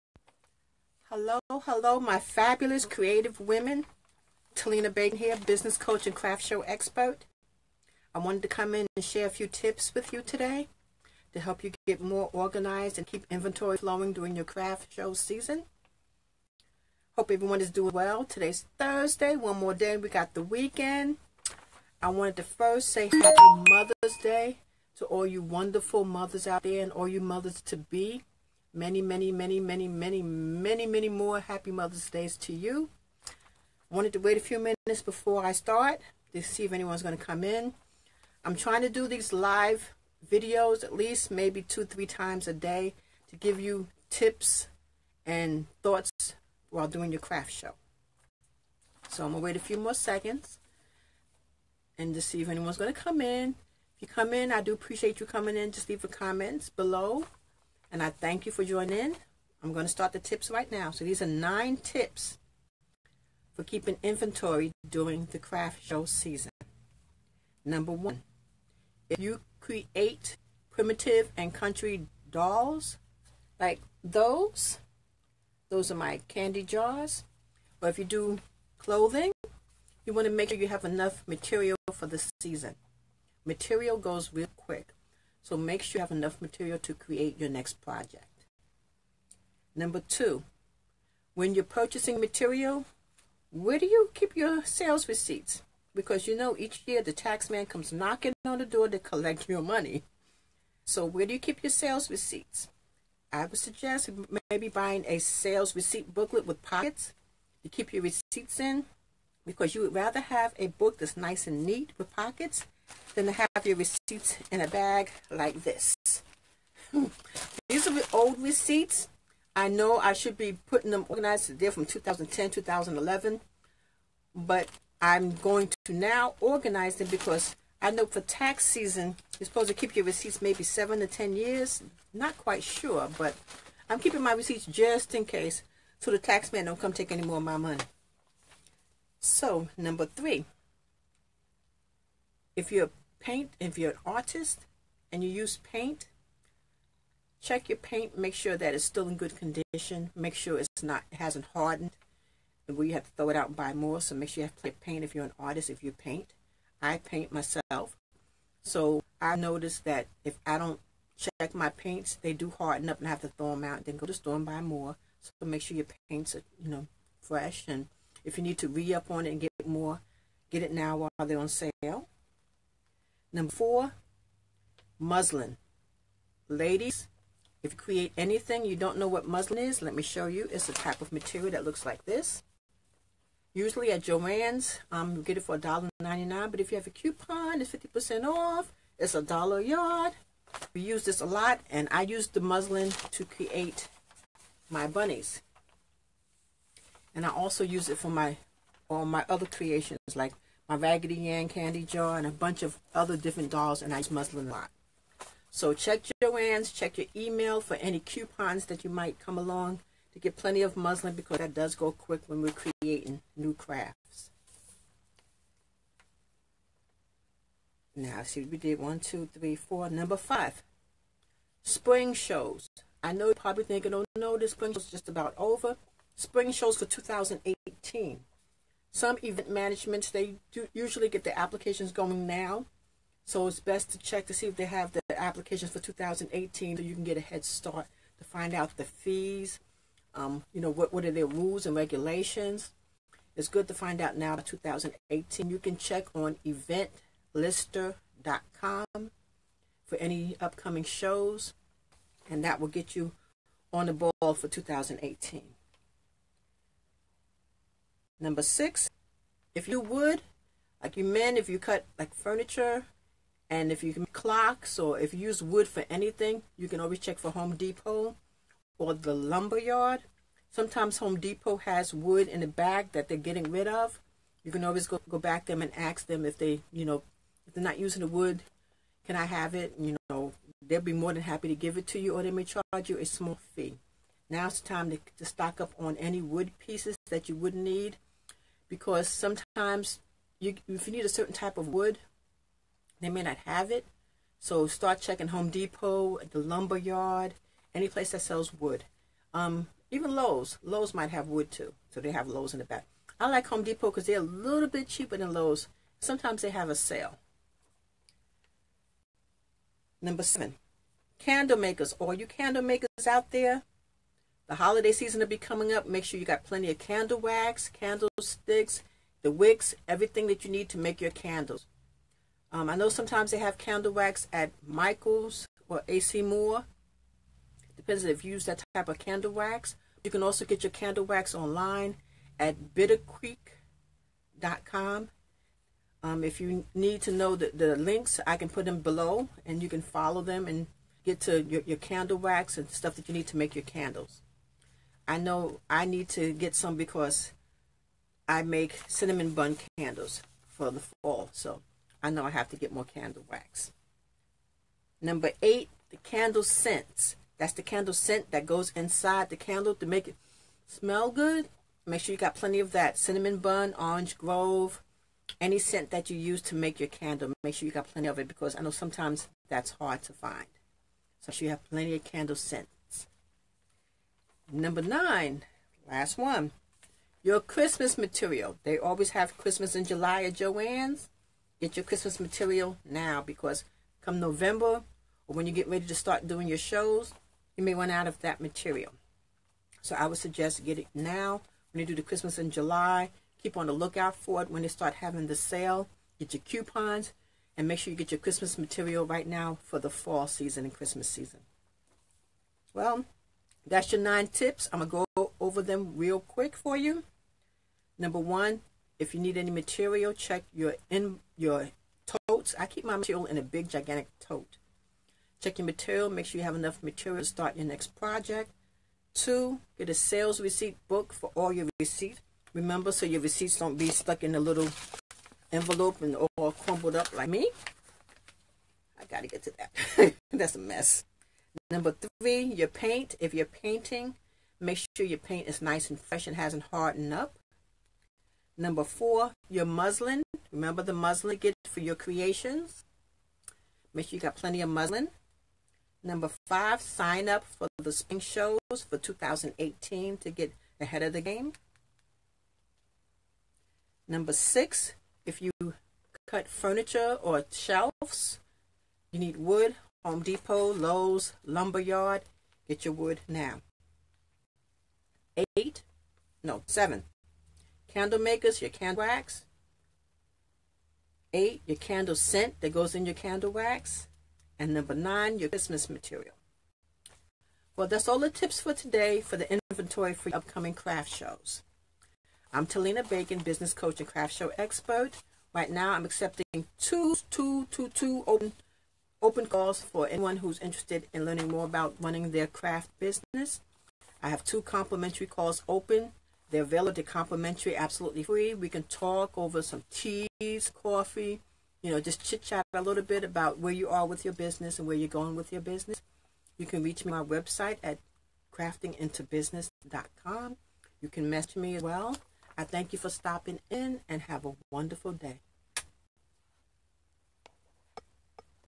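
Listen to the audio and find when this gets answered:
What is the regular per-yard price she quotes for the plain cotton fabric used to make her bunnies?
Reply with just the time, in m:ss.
3:05.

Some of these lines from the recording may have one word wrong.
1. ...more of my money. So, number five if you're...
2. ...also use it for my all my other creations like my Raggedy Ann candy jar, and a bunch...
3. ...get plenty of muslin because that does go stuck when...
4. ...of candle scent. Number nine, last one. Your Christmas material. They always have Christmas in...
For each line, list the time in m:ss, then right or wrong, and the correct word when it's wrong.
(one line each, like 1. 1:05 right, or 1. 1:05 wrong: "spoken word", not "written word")
1. 2:17 wrong: "three", not "five"
2. 3:17 right
3. 3:30 wrong: "quick", not "stuck"
4. 6:11 right.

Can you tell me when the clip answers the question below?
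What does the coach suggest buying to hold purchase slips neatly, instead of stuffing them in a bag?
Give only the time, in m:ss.
1:45.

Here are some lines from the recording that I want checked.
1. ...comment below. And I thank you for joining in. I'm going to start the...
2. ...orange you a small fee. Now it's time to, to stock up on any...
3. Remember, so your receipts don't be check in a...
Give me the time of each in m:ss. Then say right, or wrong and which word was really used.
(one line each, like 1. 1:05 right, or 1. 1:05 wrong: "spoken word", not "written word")
1. 0:56 right
2. 4:42 wrong: "charge", not "orange"
3. 7:02 wrong: "stuck", not "check".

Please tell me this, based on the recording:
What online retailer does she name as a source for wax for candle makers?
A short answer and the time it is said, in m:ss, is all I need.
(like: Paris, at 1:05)
bittercreek.com, at 5:32.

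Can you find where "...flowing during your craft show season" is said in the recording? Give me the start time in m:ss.
0:13.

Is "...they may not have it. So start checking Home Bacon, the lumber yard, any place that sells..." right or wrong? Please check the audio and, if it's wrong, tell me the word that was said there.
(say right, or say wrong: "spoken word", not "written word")
wrong: "Depot", not "Bacon".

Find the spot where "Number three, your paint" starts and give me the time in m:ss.
7:11.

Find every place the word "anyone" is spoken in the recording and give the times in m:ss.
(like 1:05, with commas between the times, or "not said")
0:36, 0:52, 8:10.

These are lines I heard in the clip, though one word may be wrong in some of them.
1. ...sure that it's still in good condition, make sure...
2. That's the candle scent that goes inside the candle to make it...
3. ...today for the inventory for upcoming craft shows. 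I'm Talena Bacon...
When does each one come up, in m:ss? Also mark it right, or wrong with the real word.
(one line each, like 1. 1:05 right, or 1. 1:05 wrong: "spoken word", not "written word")
1. 2:28 right
2. 5:57 right
3. 7:58 right.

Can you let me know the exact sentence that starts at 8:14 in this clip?
I have two complimentary calls open.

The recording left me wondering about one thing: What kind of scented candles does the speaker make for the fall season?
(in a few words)
cinnamon bun candles.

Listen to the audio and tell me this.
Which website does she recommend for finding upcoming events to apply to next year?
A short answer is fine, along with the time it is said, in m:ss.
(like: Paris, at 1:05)
eventlister.com, at 4:06.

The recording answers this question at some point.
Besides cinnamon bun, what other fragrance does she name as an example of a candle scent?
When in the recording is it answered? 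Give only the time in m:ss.
6:03.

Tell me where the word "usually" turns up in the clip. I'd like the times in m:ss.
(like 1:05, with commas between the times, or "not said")
3:03, 3:50.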